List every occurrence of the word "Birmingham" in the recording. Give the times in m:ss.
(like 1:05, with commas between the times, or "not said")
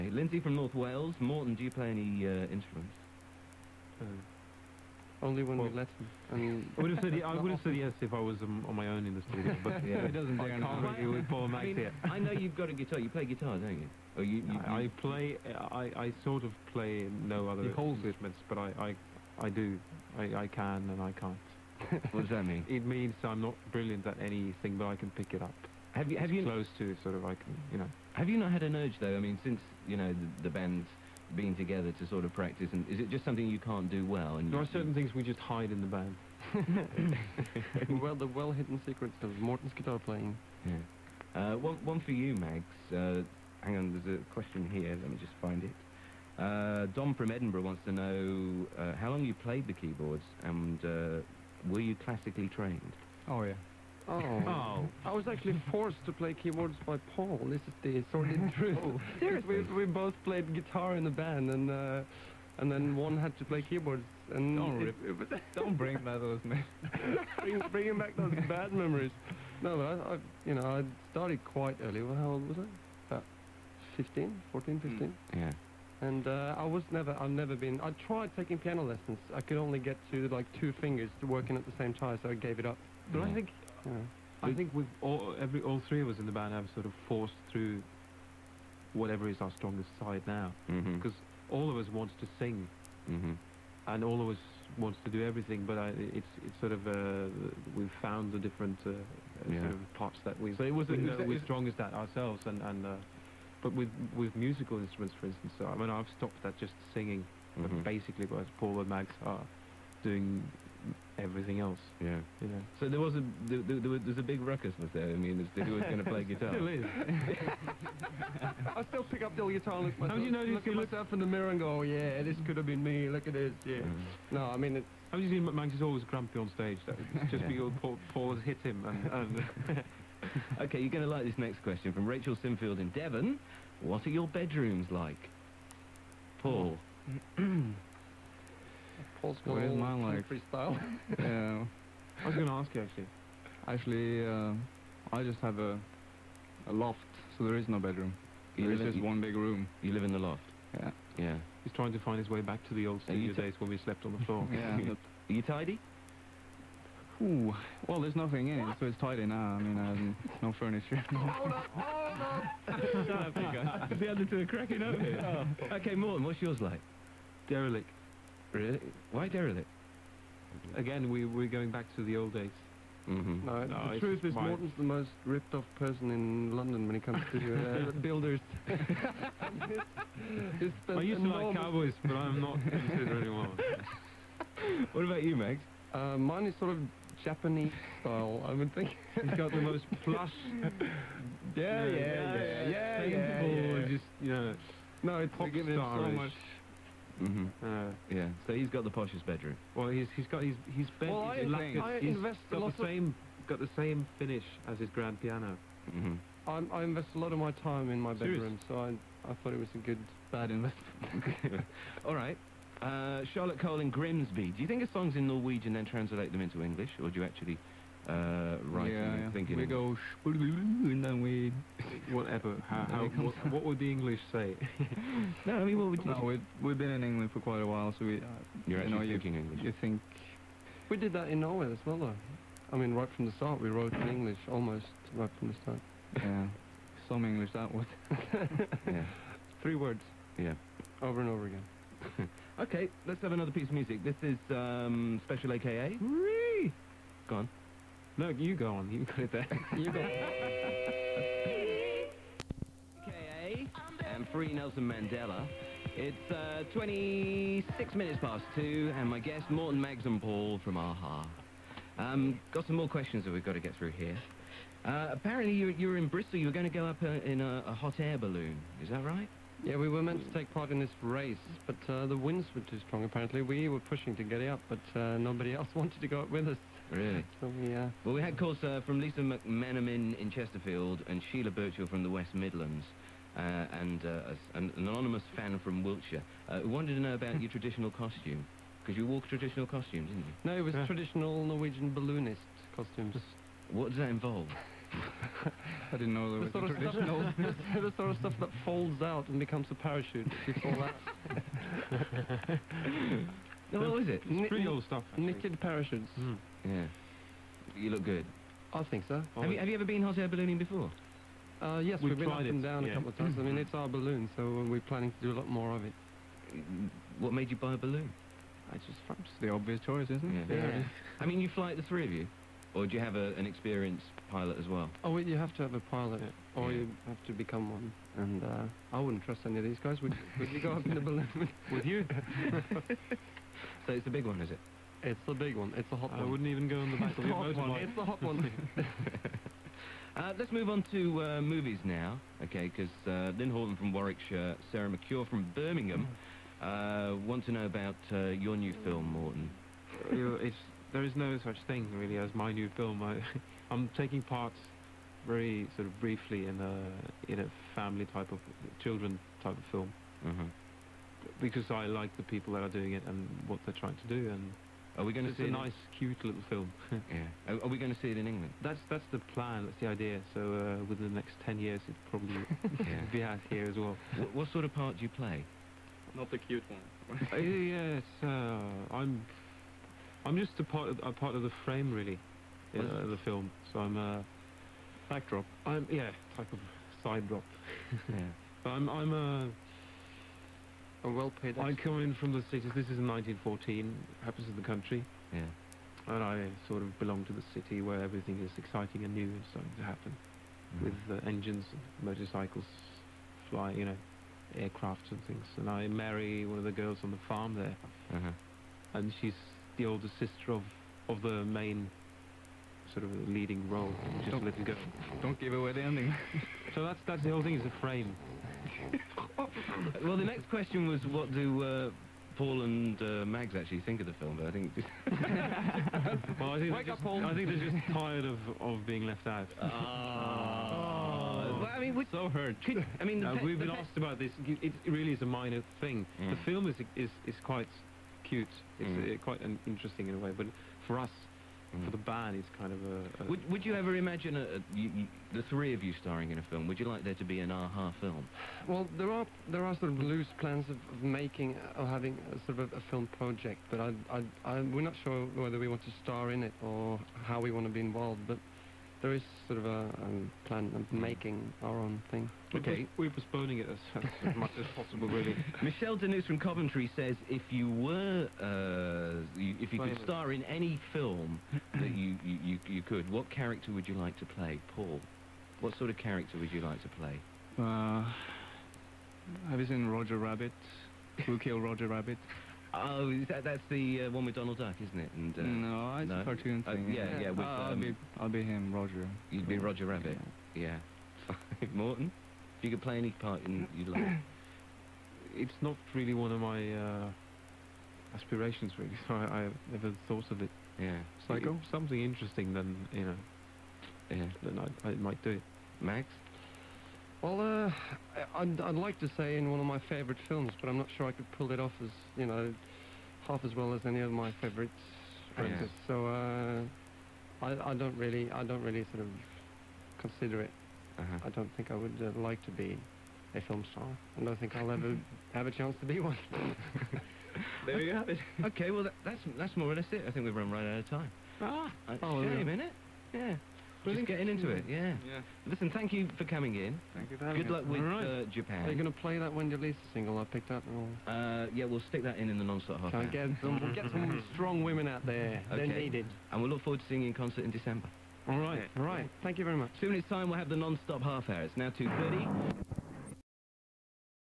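5:45.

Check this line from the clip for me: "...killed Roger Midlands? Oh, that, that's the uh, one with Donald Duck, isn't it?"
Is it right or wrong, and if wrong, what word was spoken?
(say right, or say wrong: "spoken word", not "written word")
wrong: "Rabbit", not "Midlands".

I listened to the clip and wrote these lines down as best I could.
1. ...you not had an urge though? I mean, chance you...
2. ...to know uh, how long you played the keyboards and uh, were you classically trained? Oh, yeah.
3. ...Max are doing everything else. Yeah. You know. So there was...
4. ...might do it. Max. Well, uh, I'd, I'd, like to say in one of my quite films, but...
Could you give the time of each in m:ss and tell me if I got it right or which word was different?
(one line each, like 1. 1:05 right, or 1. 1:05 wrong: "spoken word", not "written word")
1. 0:28 wrong: "since", not "chance"
2. 0:47 right
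3. 1:48 right
4. 8:24 wrong: "favourite", not "quite".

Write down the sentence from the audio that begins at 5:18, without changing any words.
Uh, it's just, the obvious choice, isn't it?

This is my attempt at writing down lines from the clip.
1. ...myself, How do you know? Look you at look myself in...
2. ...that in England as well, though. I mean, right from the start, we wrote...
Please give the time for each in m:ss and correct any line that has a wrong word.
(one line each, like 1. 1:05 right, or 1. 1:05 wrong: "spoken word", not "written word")
1. 1:59 right
2. 3:51 wrong: "Norway", not "England".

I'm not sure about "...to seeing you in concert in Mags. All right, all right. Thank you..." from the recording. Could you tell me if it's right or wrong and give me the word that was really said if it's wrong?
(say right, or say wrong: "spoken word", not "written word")
wrong: "December", not "Mags".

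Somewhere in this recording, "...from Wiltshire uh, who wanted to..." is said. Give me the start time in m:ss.
4:45.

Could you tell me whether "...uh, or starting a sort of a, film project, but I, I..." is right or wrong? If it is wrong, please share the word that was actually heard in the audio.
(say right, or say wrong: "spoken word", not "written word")
wrong: "having", not "starting".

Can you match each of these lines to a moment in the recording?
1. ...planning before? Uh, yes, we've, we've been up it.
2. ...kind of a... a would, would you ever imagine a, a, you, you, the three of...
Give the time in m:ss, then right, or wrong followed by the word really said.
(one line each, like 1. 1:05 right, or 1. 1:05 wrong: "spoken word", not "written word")
1. 5:10 wrong: "ballooning", not "planning"
2. 7:22 right.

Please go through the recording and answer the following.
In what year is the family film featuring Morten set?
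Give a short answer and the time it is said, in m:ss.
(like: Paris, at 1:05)
1914, at 6:33.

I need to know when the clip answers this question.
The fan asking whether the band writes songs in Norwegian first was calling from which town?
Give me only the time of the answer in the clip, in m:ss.
3:33.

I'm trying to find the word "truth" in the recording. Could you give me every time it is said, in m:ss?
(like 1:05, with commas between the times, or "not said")
0:58, 2:53.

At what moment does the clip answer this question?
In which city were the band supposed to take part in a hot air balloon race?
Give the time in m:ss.
4:26.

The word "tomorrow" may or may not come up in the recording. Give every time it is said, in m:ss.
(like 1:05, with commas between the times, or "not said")
not said.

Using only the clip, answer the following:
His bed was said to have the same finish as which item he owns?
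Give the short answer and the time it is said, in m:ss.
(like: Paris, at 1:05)
His grand piano, at 3:24.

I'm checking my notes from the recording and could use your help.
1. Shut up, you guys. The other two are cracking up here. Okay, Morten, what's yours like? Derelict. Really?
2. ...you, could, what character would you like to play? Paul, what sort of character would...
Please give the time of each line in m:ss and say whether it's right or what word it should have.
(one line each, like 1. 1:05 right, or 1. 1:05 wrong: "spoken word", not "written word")
1. 2:43 right
2. 7:52 right.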